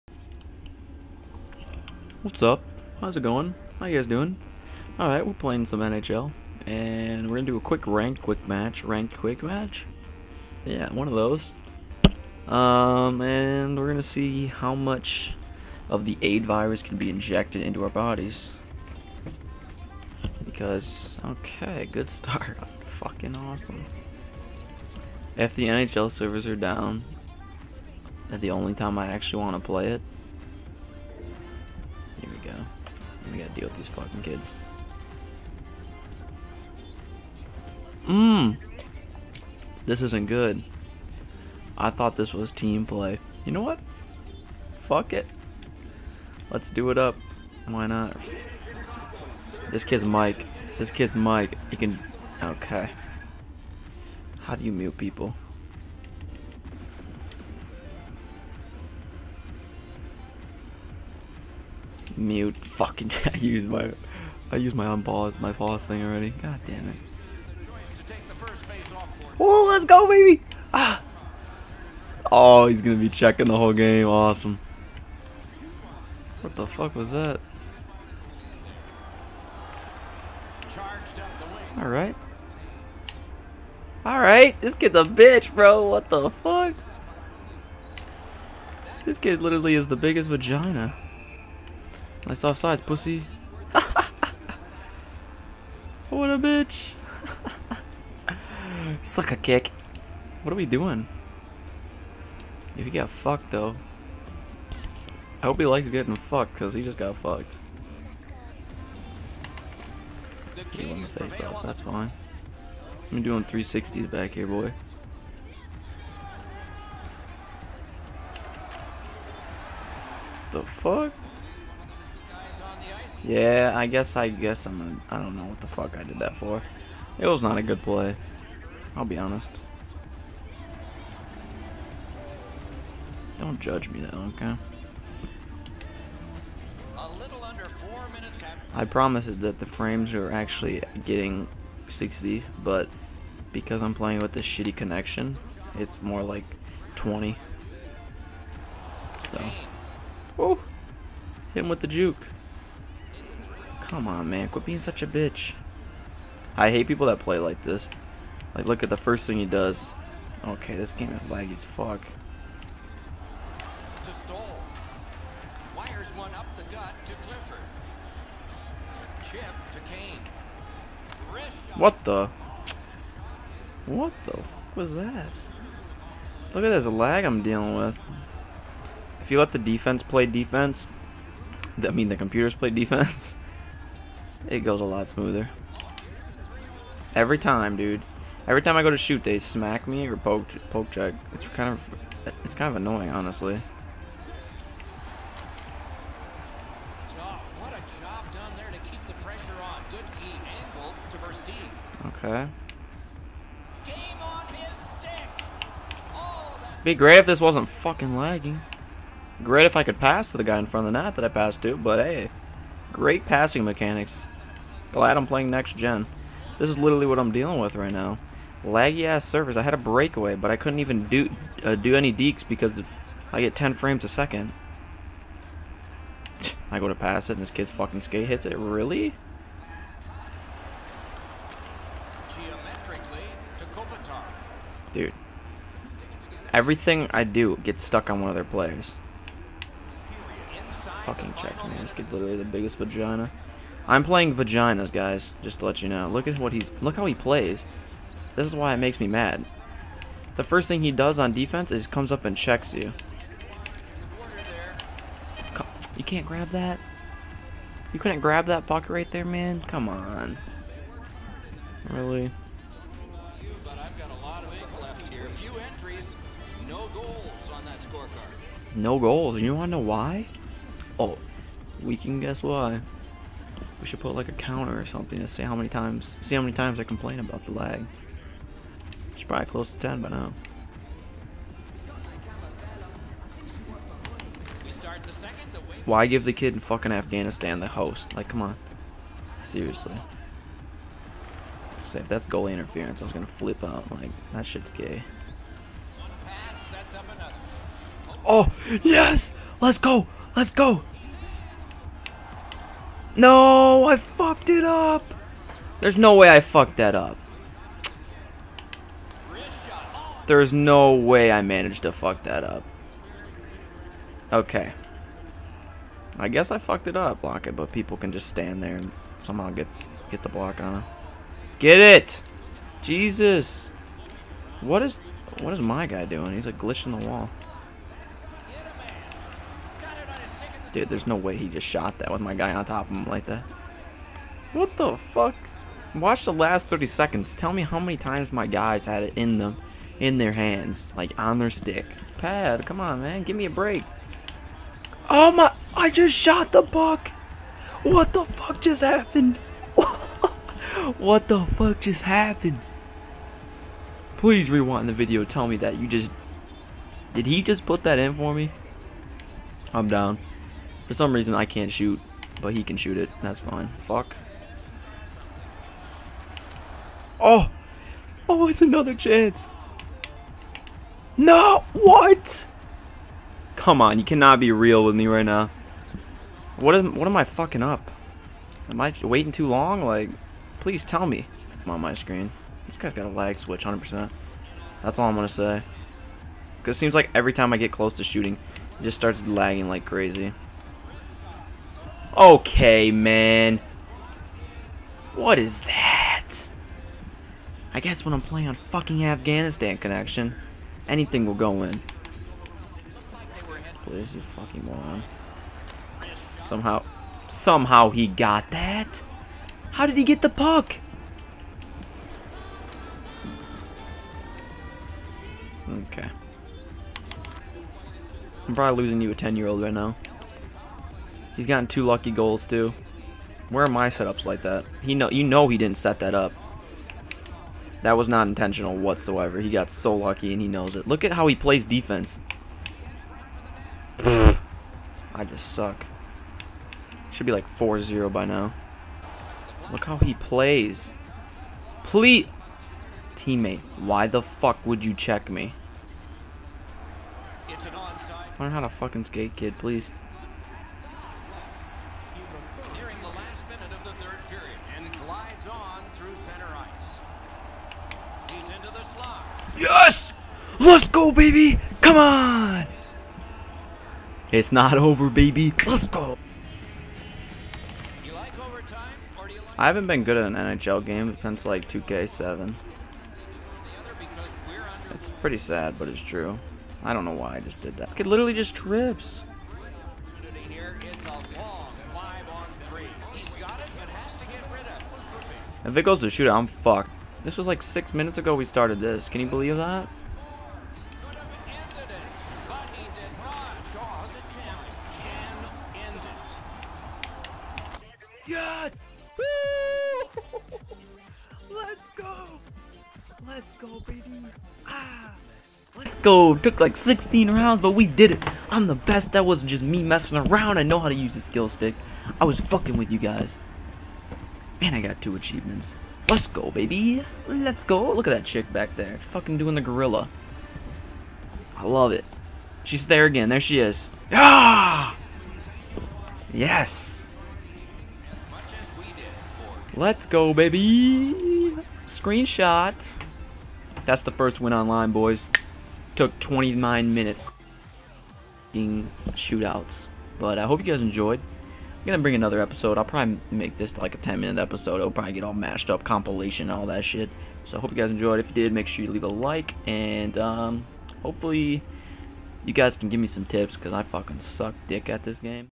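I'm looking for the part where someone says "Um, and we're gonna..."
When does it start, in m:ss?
0:12.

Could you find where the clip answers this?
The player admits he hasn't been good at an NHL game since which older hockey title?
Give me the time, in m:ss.
7:51.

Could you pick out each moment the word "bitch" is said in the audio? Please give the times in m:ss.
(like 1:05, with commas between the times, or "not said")
1:25, 1:36, 2:35.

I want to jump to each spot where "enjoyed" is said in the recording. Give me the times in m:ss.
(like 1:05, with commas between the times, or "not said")
9:00, 9:07.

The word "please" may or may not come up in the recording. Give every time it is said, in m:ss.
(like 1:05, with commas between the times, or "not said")
5:54, 6:20, 6:43, 7:21, 7:29.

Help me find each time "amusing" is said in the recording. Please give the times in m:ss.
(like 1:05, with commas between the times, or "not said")
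not said.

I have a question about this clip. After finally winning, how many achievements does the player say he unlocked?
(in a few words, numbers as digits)
2.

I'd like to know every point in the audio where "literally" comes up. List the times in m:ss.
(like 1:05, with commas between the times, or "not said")
1:29, 3:36, 4:02, 7:58.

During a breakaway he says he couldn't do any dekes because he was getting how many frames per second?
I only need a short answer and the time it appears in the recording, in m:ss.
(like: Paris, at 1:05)
10, at 3:43.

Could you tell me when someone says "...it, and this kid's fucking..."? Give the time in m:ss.
3:47.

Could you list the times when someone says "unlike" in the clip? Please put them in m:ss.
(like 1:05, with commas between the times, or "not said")
not said.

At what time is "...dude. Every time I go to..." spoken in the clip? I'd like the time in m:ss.
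3:07.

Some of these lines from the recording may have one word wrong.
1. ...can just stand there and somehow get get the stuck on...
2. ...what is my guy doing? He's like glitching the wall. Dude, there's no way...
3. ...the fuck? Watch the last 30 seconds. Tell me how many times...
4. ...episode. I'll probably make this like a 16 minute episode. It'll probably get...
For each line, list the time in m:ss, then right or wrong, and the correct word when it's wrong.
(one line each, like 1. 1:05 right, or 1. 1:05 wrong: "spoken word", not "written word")
1. 5:17 wrong: "block", not "stuck"
2. 5:25 right
3. 5:34 right
4. 9:02 wrong: "10", not "16".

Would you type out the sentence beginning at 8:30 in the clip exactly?
I know how to use the skill stick.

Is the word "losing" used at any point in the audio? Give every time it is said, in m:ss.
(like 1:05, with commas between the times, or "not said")
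6:58.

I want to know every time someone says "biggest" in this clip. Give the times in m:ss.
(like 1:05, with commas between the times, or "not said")
1:29, 4:02.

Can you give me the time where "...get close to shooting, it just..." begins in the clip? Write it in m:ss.
6:27.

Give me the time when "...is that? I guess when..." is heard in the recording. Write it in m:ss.
6:35.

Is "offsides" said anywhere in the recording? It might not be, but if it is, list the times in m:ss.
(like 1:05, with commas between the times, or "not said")
1:32.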